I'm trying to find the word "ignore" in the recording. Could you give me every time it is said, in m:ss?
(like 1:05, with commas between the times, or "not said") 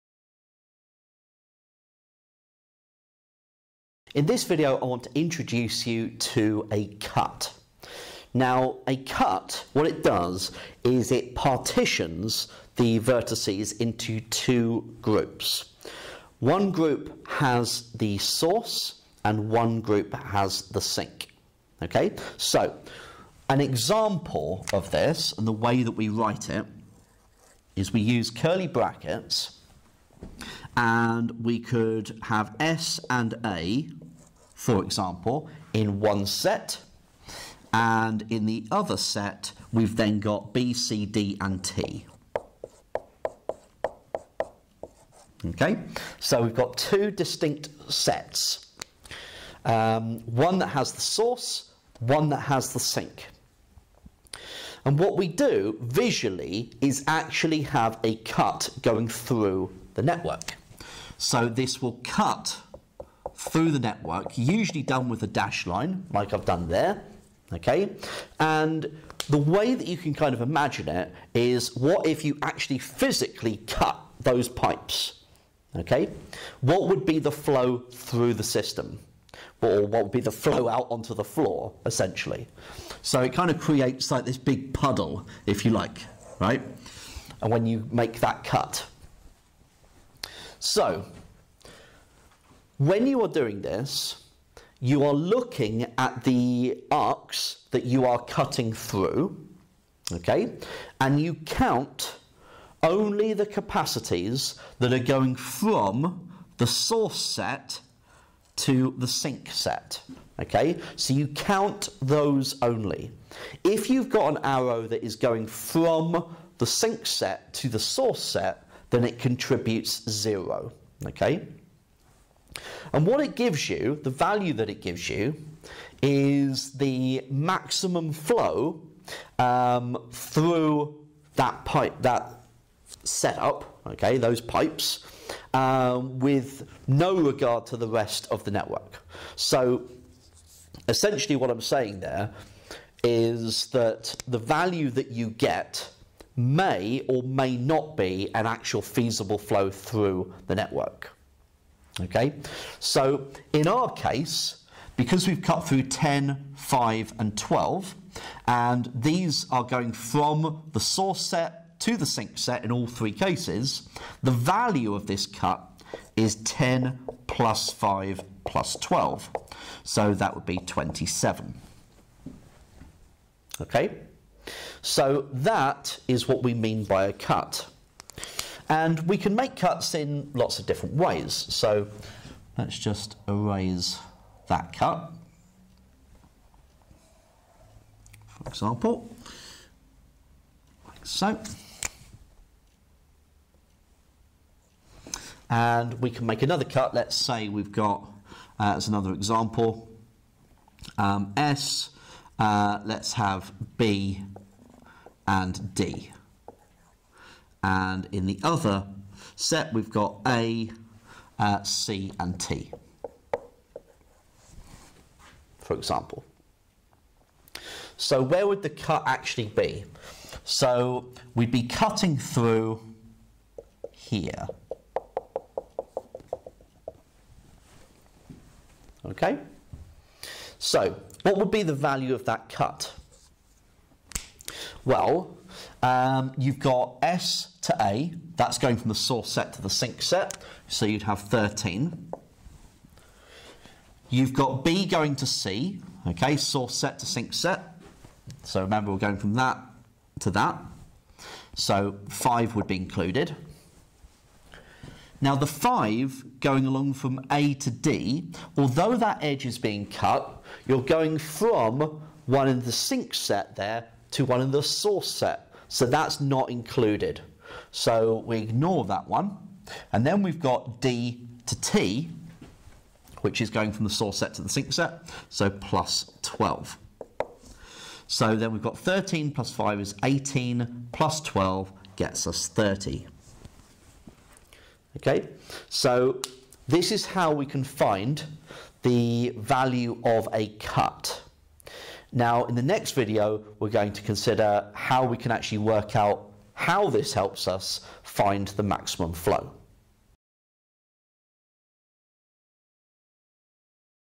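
4:28.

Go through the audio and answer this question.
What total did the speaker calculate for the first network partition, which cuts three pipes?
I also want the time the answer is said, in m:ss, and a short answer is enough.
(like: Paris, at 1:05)
27, at 2:50.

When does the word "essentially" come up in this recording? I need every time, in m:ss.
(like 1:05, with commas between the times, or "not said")
1:21, 2:20.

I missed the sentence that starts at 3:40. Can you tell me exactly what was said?
So we'd be cutting through here.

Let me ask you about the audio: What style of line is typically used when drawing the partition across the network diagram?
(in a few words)
dash line.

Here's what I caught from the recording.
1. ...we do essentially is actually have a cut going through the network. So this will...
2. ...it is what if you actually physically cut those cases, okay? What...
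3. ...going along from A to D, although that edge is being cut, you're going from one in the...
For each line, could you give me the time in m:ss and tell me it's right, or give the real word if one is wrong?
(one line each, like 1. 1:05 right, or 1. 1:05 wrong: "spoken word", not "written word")
1. 0:55 wrong: "visually", not "essentially"
2. 1:10 wrong: "pipes", not "cases"
3. 4:16 right.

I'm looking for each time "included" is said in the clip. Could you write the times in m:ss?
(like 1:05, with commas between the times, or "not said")
4:12, 4:26.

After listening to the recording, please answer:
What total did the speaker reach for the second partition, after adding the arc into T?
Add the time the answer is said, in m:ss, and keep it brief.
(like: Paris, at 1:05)
30, at 4:42.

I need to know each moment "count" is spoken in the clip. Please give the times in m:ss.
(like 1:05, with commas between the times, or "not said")
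1:41, 1:51.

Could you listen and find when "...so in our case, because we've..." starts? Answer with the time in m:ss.
2:32.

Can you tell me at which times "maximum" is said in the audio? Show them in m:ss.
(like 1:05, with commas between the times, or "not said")
2:07, 4:58.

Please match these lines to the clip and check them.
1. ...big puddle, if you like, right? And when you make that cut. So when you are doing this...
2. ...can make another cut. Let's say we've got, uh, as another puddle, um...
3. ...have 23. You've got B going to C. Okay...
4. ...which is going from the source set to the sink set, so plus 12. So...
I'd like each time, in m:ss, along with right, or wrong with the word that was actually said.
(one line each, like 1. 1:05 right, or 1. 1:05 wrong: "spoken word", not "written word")
1. 1:24 right
2. 3:16 wrong: "example", not "puddle"
3. 4:01 wrong: "13", not "23"
4. 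4:33 right.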